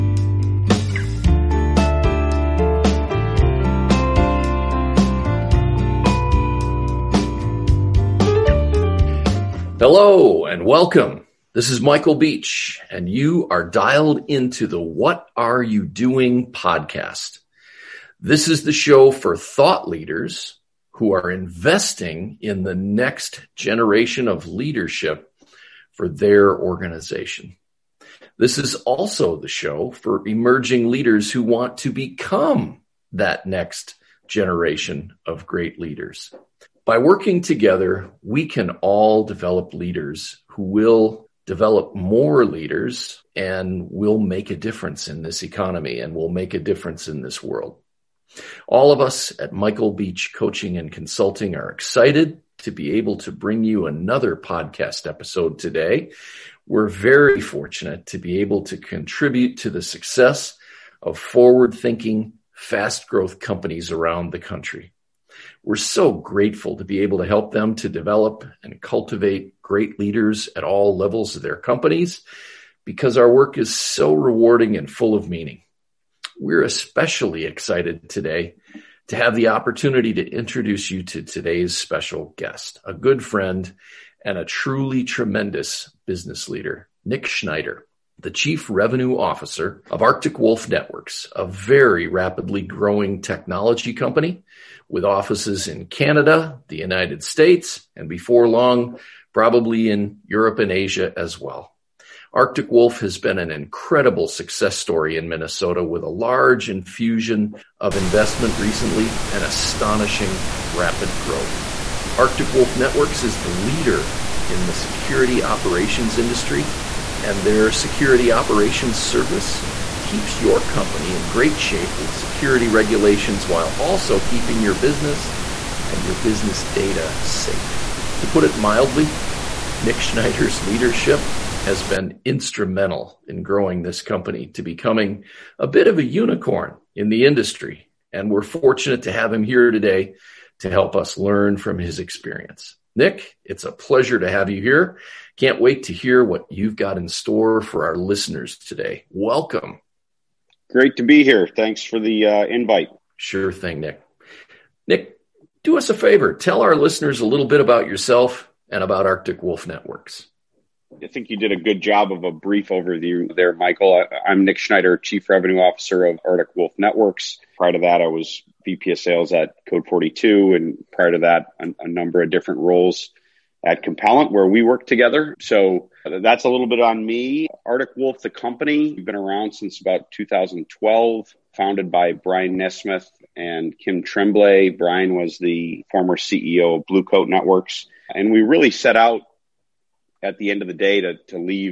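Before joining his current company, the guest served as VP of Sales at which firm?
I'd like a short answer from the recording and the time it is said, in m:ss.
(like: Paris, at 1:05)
Code 42, at 2:49.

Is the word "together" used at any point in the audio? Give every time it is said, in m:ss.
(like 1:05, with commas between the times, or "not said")
0:37, 2:54.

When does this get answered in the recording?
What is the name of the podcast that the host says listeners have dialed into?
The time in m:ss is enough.
0:14.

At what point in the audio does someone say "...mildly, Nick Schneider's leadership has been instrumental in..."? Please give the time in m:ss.
2:08.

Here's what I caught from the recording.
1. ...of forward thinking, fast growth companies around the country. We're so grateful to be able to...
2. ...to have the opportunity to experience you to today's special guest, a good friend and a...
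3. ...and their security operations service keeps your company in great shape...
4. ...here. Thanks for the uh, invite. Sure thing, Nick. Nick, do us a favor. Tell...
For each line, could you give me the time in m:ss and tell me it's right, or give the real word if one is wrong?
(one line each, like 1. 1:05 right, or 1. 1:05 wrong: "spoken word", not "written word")
1. 1:01 right
2. 1:19 wrong: "introduce", not "experience"
3. 1:57 right
4. 2:31 right.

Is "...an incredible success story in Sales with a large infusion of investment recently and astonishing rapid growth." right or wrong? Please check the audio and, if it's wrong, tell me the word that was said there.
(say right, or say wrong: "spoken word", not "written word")
wrong: "Minnesota", not "Sales".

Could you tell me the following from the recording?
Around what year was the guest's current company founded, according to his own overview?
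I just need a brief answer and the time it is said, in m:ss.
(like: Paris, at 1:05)
2012, at 3:00.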